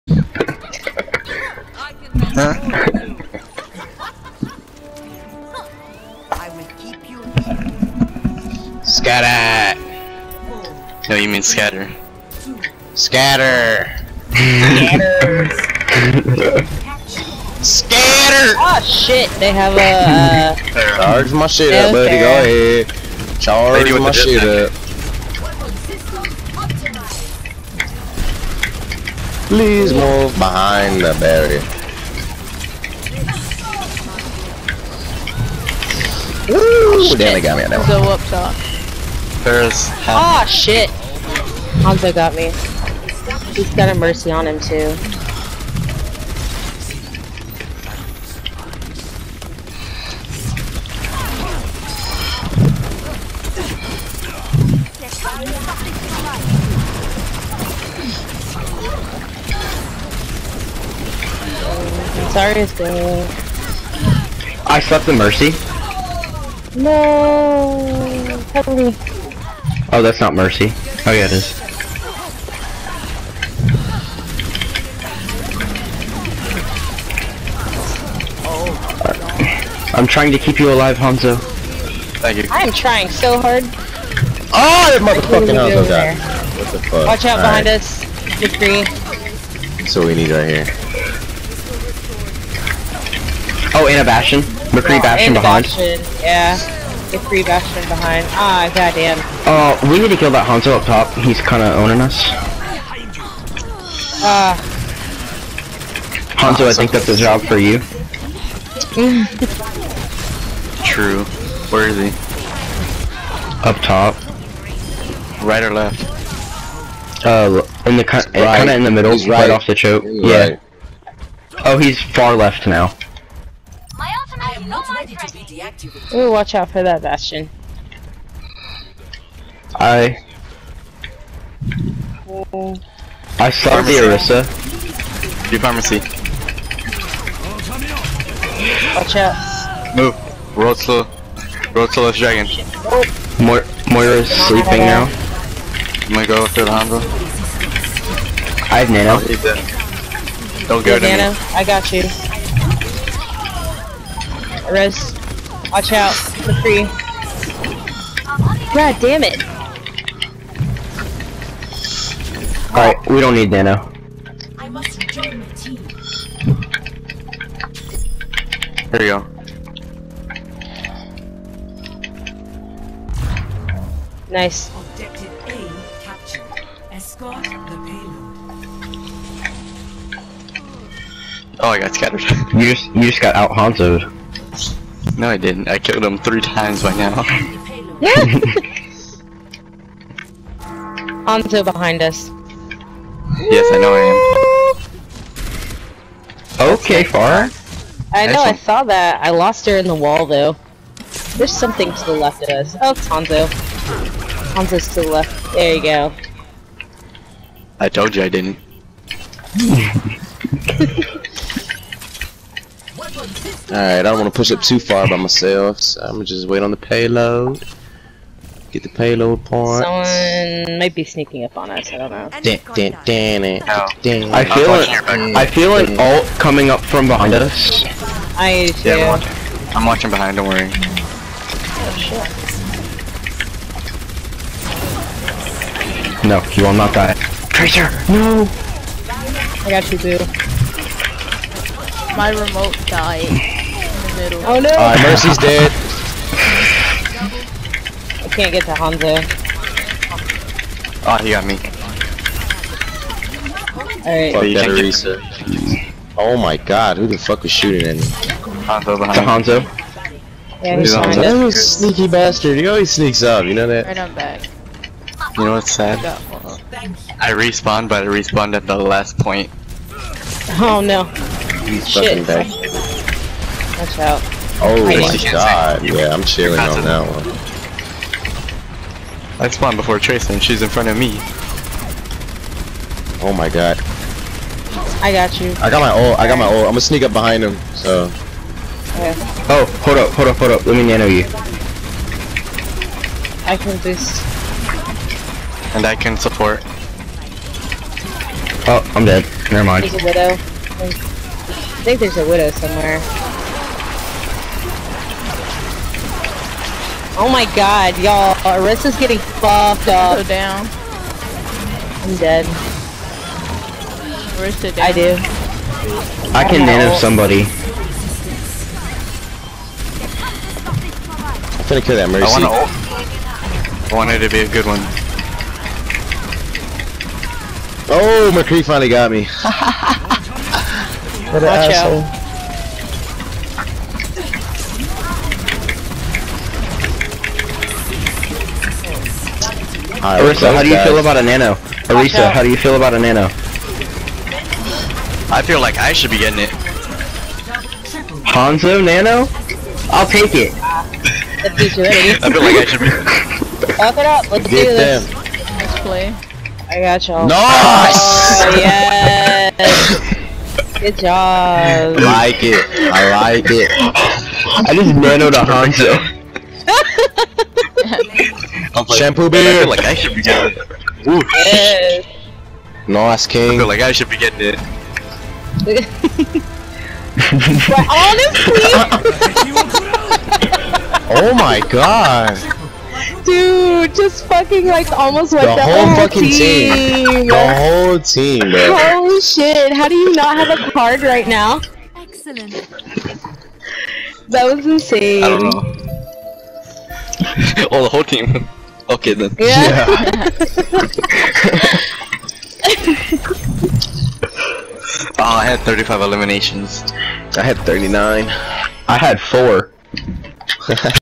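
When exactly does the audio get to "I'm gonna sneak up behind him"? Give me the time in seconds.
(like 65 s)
286 s.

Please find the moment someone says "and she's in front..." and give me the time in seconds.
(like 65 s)
280 s.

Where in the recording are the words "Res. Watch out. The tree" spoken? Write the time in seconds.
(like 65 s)
154 s.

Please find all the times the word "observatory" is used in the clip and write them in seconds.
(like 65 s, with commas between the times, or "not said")
not said.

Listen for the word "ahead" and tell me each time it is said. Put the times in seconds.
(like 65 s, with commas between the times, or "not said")
22 s.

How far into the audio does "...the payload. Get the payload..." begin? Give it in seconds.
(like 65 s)
216 s.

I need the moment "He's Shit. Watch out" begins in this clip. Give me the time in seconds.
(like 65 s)
271 s.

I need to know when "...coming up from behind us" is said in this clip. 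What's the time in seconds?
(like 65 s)
226 s.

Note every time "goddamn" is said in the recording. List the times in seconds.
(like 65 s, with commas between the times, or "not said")
98 s.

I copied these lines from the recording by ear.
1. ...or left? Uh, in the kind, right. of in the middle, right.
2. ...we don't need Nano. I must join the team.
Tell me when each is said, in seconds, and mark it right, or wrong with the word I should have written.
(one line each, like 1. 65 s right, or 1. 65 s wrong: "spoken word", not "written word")
1. 115 s right
2. 163 s right.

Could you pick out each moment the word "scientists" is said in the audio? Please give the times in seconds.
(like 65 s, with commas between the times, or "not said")
not said.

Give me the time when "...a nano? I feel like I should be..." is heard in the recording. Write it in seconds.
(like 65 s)
342 s.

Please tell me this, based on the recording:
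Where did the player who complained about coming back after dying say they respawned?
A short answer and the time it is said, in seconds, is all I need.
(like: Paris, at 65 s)
at the last point, at 268 s.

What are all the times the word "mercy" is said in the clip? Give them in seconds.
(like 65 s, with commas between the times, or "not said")
43 s, 65 s, 70 s, 245 s, 322 s.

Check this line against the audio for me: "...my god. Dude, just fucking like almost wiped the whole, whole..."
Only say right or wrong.
right.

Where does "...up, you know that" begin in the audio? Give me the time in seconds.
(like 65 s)
263 s.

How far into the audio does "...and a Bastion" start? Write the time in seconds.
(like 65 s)
93 s.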